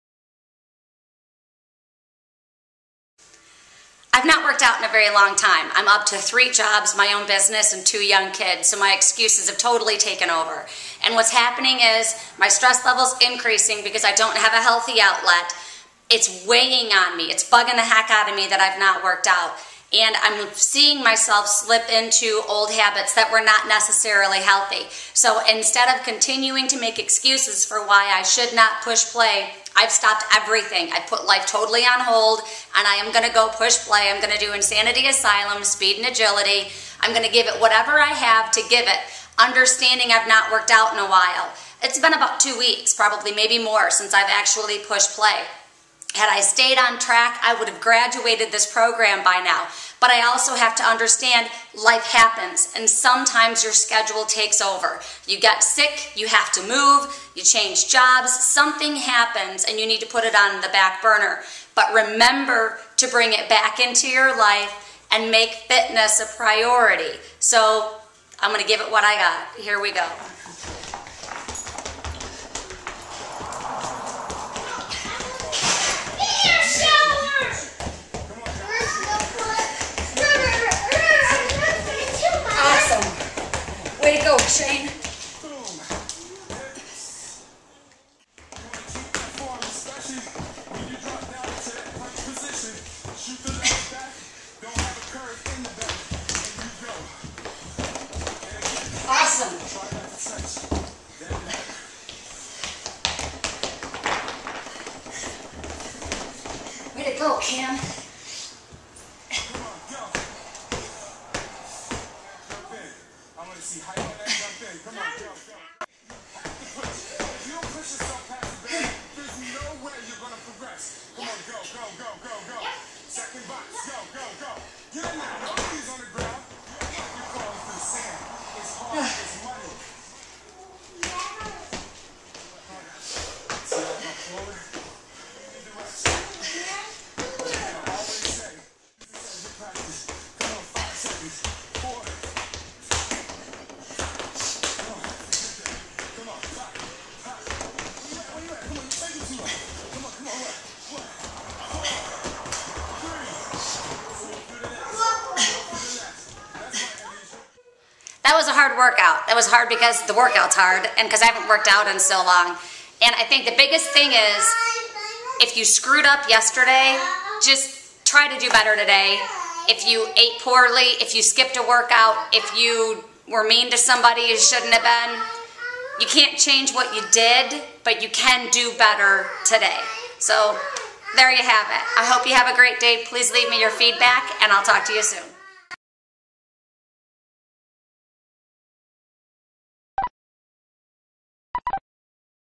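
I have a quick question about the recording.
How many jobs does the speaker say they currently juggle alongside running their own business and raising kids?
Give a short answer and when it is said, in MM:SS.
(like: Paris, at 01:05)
3, at 00:06.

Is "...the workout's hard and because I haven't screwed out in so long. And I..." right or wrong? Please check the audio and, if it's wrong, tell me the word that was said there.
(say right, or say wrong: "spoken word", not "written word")
wrong: "worked", not "screwed".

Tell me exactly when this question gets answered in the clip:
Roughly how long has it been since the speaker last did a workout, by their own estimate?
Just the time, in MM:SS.
00:42.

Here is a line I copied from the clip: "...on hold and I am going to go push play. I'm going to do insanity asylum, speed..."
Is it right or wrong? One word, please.
right.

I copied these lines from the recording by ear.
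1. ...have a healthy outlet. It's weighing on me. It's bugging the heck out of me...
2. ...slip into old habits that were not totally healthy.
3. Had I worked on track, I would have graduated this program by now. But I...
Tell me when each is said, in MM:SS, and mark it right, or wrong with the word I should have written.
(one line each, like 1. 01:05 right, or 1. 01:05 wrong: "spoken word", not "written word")
1. 00:14 right
2. 00:21 wrong: "necessarily", not "totally"
3. 00:46 wrong: "stayed", not "worked".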